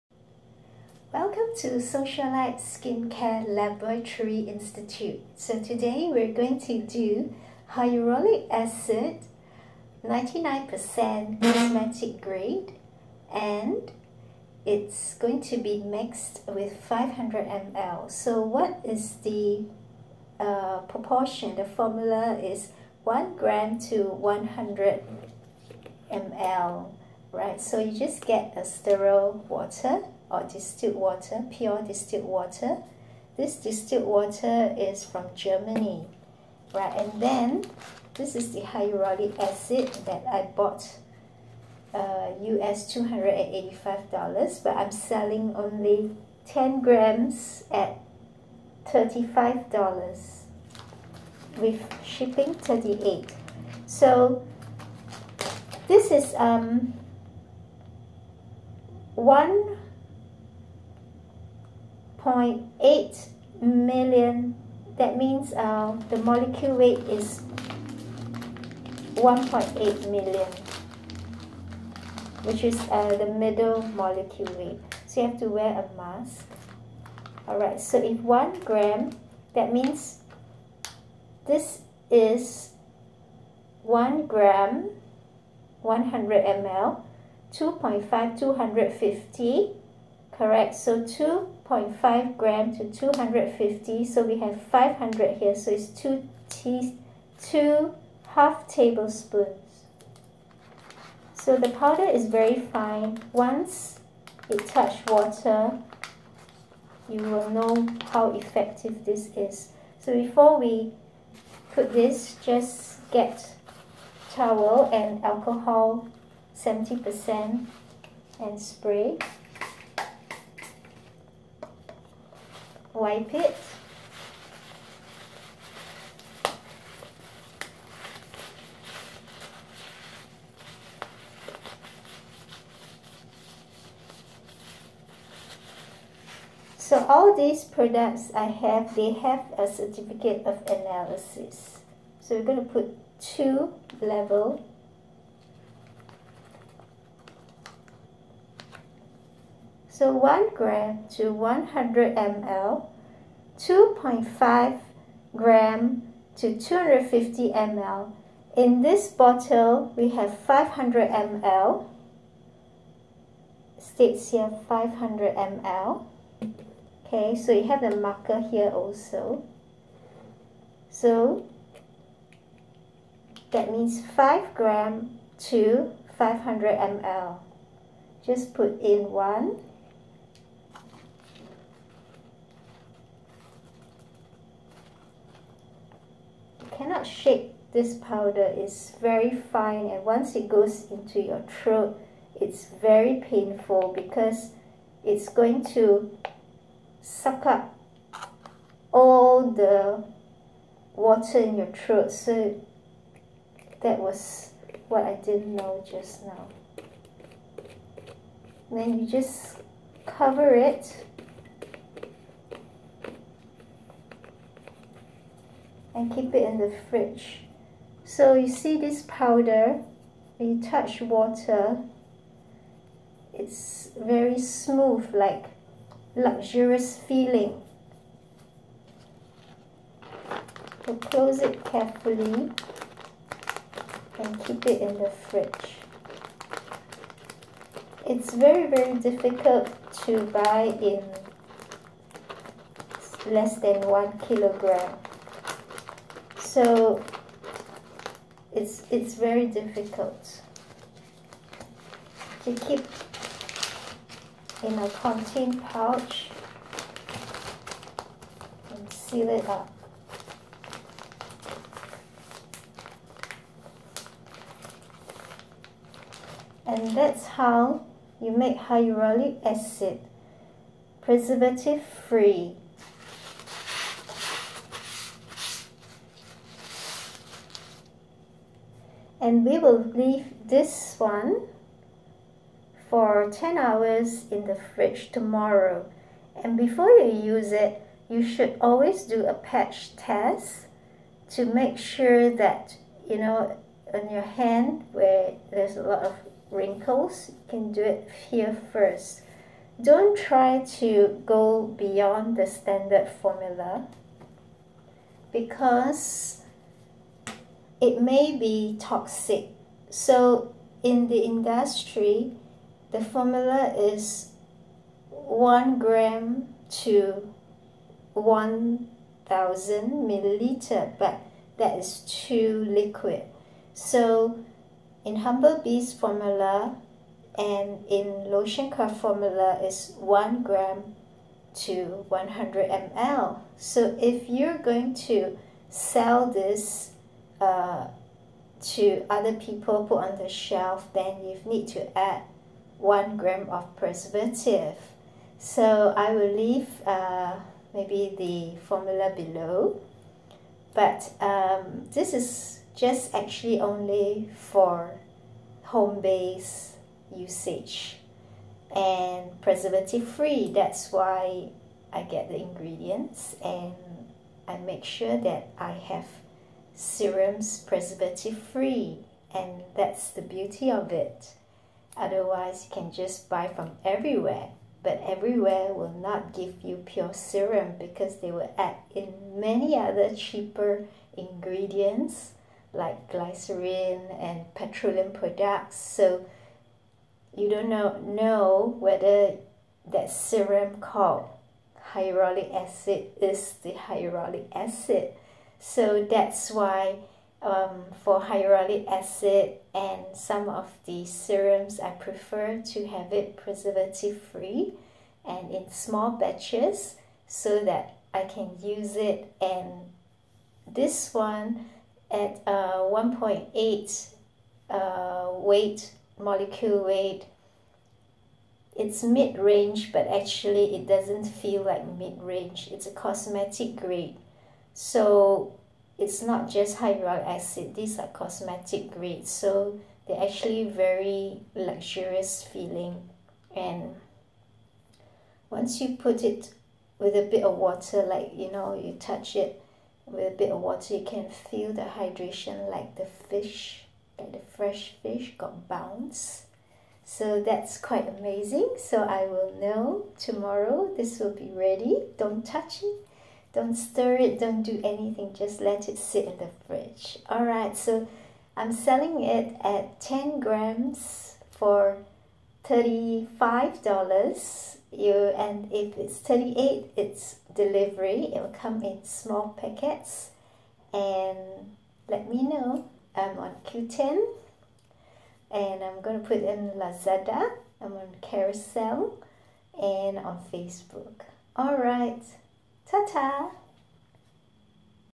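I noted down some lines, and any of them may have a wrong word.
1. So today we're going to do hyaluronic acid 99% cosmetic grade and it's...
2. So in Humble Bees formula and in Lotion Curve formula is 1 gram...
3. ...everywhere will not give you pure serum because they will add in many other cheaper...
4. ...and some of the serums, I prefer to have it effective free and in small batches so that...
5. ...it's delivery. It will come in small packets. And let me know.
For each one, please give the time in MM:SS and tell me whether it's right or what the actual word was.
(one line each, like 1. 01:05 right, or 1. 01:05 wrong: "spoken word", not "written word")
1. 00:05 right
2. 05:23 right
3. 06:15 right
4. 06:39 wrong: "preservative", not "effective"
5. 07:46 right.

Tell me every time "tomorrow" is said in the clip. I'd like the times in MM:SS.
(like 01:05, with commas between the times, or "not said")
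04:45, 07:30.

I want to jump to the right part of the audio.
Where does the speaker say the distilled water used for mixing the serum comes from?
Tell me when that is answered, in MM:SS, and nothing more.
00:35.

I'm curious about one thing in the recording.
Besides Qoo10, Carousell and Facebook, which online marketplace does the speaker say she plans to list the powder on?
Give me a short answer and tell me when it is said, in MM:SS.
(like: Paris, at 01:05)
Lazada, at 07:56.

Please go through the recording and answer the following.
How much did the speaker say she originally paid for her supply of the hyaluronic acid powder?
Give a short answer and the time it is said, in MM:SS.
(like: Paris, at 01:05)
US $285, at 00:42.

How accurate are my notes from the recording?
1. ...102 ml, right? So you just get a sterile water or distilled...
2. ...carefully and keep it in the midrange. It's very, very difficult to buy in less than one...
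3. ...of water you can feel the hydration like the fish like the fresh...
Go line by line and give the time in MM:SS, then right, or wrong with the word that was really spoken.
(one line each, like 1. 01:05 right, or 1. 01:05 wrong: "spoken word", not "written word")
1. 00:24 wrong: "100", not "102"
2. 03:51 wrong: "fridge", not "midrange"
3. 07:20 right.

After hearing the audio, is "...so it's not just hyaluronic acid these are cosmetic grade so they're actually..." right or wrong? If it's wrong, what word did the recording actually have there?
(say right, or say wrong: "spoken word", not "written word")
right.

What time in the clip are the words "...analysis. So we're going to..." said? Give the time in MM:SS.
02:20.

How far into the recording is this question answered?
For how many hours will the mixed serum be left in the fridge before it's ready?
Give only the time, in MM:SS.
04:43.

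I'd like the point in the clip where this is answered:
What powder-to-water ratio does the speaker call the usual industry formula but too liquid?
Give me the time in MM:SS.
05:15.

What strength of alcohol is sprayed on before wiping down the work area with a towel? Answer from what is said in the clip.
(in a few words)
70%.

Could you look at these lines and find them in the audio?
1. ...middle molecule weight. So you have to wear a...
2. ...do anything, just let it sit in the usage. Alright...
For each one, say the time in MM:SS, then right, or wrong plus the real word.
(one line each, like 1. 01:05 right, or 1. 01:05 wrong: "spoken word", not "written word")
1. 01:13 right
2. 07:34 wrong: "fridge", not "usage".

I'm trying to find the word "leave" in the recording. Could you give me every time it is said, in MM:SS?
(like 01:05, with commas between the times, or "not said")
04:39, 05:46.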